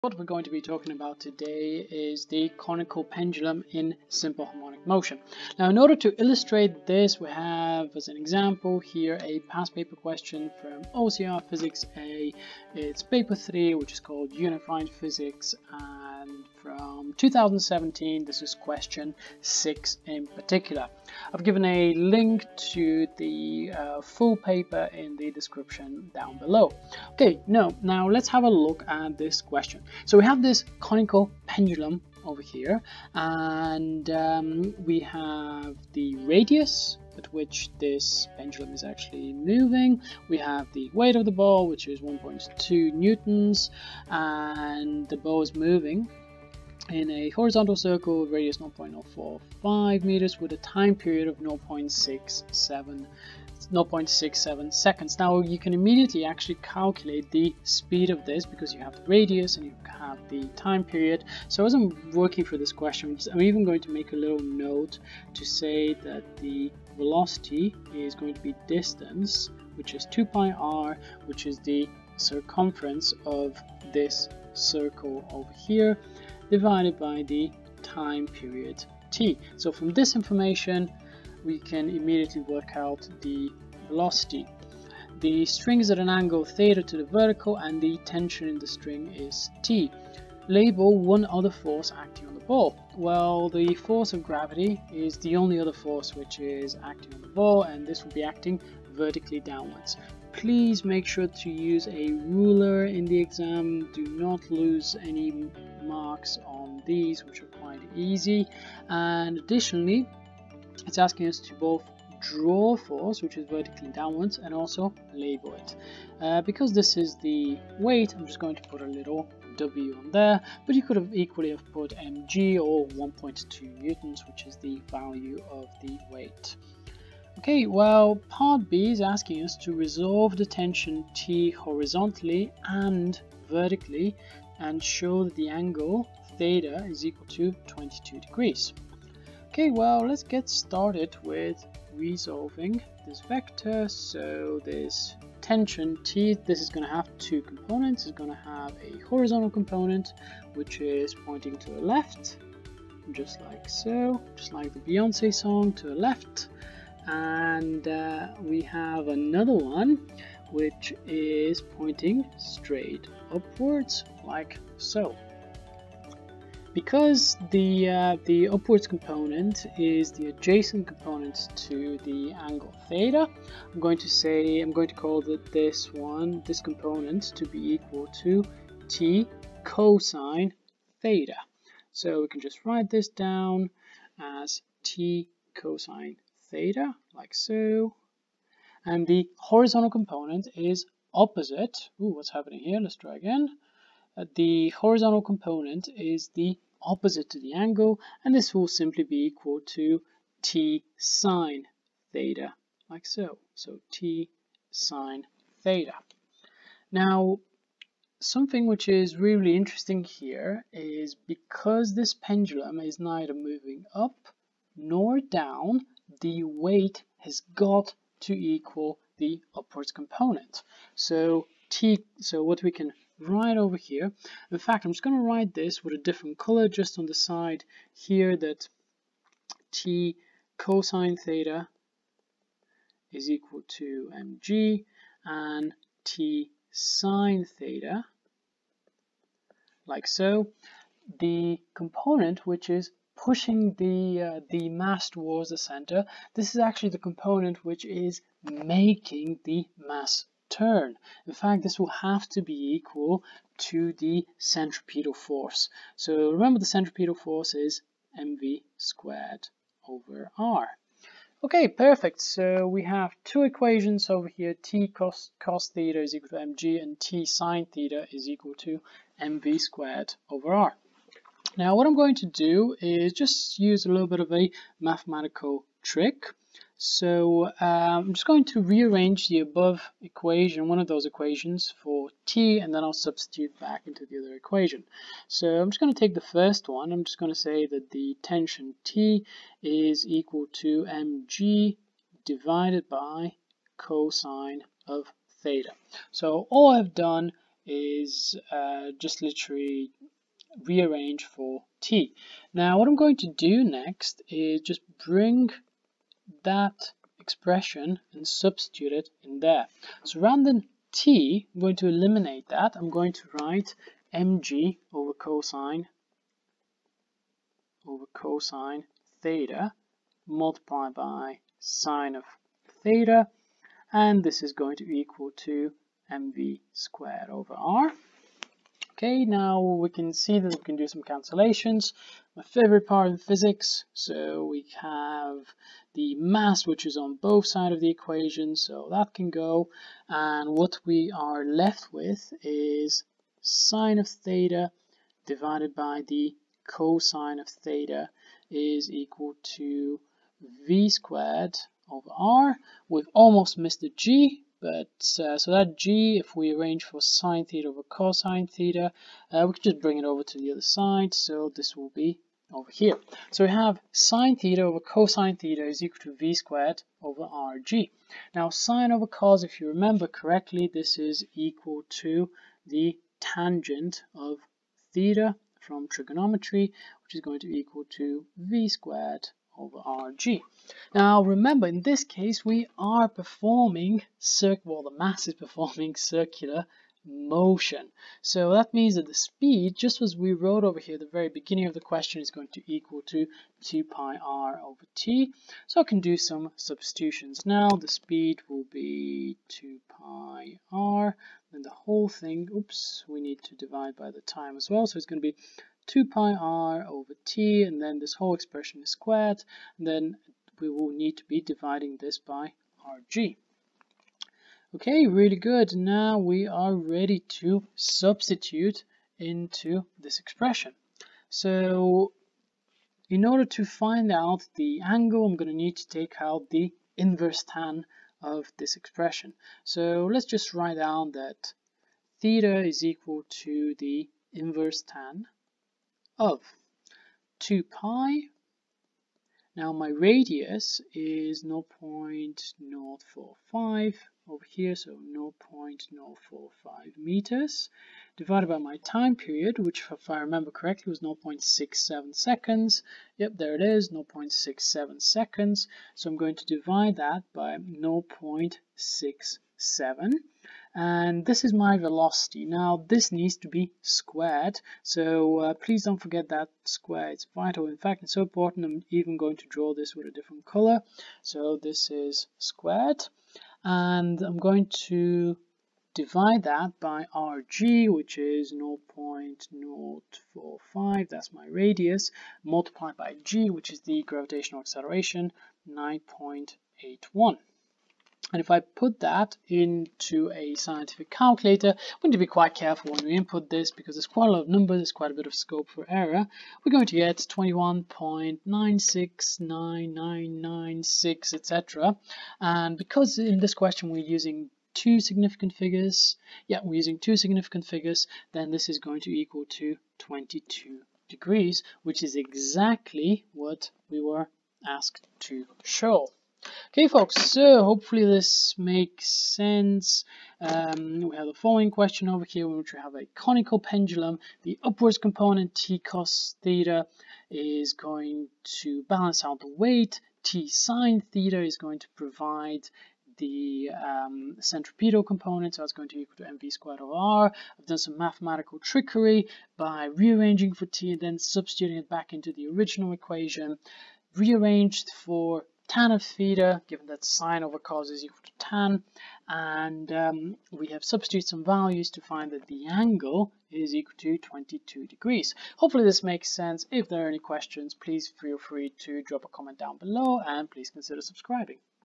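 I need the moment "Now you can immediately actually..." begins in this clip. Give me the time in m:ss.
0:55.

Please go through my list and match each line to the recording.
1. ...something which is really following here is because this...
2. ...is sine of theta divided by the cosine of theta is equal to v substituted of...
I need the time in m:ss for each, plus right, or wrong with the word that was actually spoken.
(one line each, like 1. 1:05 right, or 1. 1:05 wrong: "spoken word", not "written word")
1. 3:28 wrong: "interesting", not "following"
2. 5:42 wrong: "squared", not "substituted".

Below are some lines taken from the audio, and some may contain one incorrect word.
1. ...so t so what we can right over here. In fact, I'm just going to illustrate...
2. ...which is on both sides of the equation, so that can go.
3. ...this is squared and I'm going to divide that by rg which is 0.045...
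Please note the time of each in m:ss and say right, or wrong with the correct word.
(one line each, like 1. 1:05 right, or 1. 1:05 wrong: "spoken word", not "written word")
1. 3:40 wrong: "write", not "illustrate"
2. 5:36 right
3. 7:51 right.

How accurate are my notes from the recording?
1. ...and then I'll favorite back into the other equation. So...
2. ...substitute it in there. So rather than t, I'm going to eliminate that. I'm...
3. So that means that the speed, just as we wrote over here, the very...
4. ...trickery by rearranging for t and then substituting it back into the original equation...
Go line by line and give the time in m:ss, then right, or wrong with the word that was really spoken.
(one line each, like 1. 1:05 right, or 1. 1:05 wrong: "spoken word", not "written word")
1. 4:42 wrong: "substitute", not "favorite"
2. 5:08 right
3. 6:28 right
4. 8:58 right.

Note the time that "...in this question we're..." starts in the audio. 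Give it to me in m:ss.
8:23.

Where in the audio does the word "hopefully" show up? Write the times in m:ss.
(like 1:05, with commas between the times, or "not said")
8:37, 9:15.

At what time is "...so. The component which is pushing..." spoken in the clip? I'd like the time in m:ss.
4:00.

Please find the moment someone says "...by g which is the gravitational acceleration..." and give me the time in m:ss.
8:02.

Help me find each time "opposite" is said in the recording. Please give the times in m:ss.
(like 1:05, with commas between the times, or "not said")
3:11, 3:16.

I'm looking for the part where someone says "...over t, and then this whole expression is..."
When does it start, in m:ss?
6:46.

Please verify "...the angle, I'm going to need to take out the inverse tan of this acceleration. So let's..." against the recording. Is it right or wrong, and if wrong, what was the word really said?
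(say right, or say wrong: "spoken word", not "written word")
wrong: "expression", not "acceleration".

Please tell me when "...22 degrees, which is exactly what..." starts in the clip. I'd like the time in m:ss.
8:29.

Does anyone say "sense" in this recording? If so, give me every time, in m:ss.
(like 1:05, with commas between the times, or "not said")
8:39, 9:16.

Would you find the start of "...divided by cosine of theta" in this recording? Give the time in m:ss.
4:52.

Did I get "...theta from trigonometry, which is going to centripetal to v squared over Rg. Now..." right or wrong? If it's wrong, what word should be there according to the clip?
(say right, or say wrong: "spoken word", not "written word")
wrong: "equal", not "centripetal".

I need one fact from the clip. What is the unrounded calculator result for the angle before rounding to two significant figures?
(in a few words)
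21.969996.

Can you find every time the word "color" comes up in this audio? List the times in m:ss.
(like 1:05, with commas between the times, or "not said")
3:46, 7:50.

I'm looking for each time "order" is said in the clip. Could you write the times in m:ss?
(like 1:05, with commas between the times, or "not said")
0:05, 7:03.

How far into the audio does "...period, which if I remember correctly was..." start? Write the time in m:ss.
7:29.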